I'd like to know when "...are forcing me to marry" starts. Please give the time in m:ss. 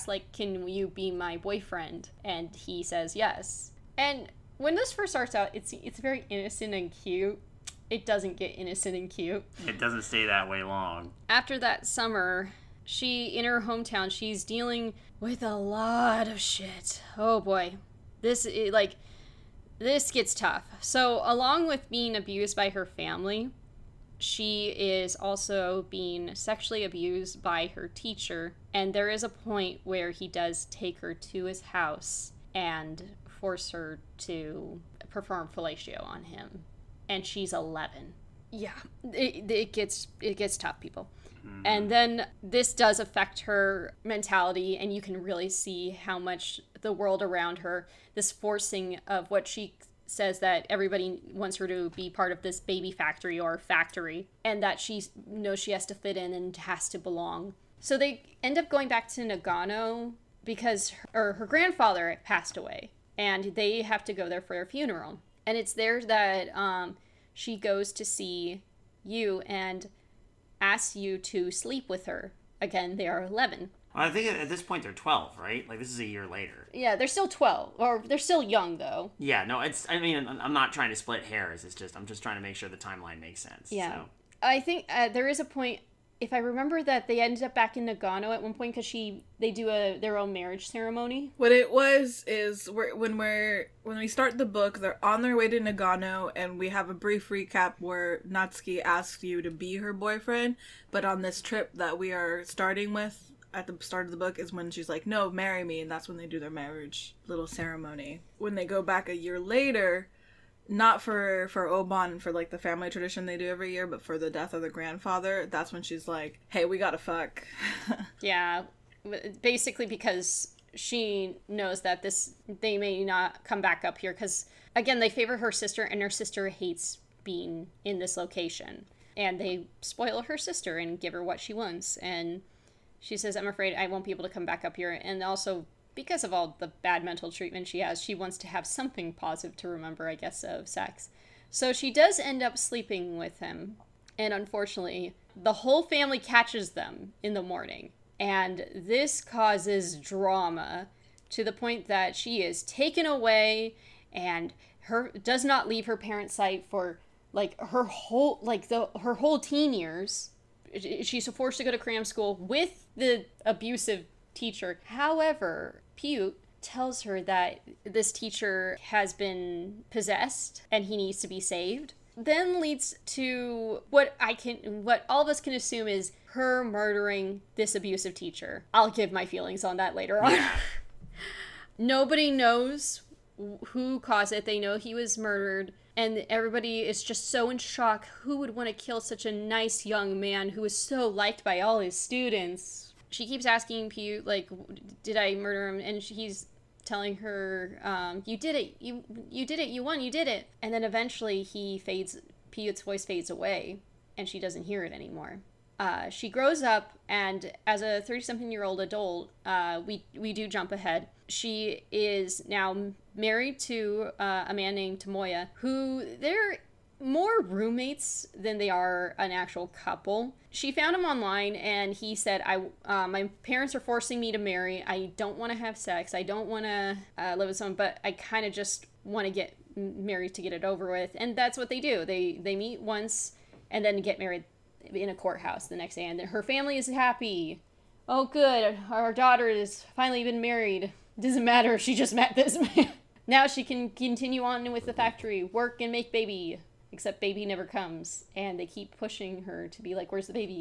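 3:43.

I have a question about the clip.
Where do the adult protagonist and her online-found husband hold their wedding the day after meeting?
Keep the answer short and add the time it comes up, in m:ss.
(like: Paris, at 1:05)
Courthouse, at 3:55.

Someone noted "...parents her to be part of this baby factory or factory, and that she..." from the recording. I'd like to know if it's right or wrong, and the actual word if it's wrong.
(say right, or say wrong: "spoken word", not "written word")
wrong: "wants", not "parents".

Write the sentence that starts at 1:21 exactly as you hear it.
It's just I'm just trying to make sure the timeline makes sense.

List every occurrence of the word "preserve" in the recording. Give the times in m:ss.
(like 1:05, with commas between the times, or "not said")
not said.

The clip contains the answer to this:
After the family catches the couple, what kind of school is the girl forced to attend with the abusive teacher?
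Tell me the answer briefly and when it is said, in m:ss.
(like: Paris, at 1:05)
Cram school, at 2:41.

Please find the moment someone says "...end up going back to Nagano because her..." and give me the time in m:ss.
0:58.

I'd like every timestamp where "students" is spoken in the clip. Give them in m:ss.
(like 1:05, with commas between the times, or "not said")
3:11.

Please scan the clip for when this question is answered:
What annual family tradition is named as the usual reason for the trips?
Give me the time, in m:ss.
1:51.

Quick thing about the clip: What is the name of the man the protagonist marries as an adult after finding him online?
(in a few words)
Tomoya.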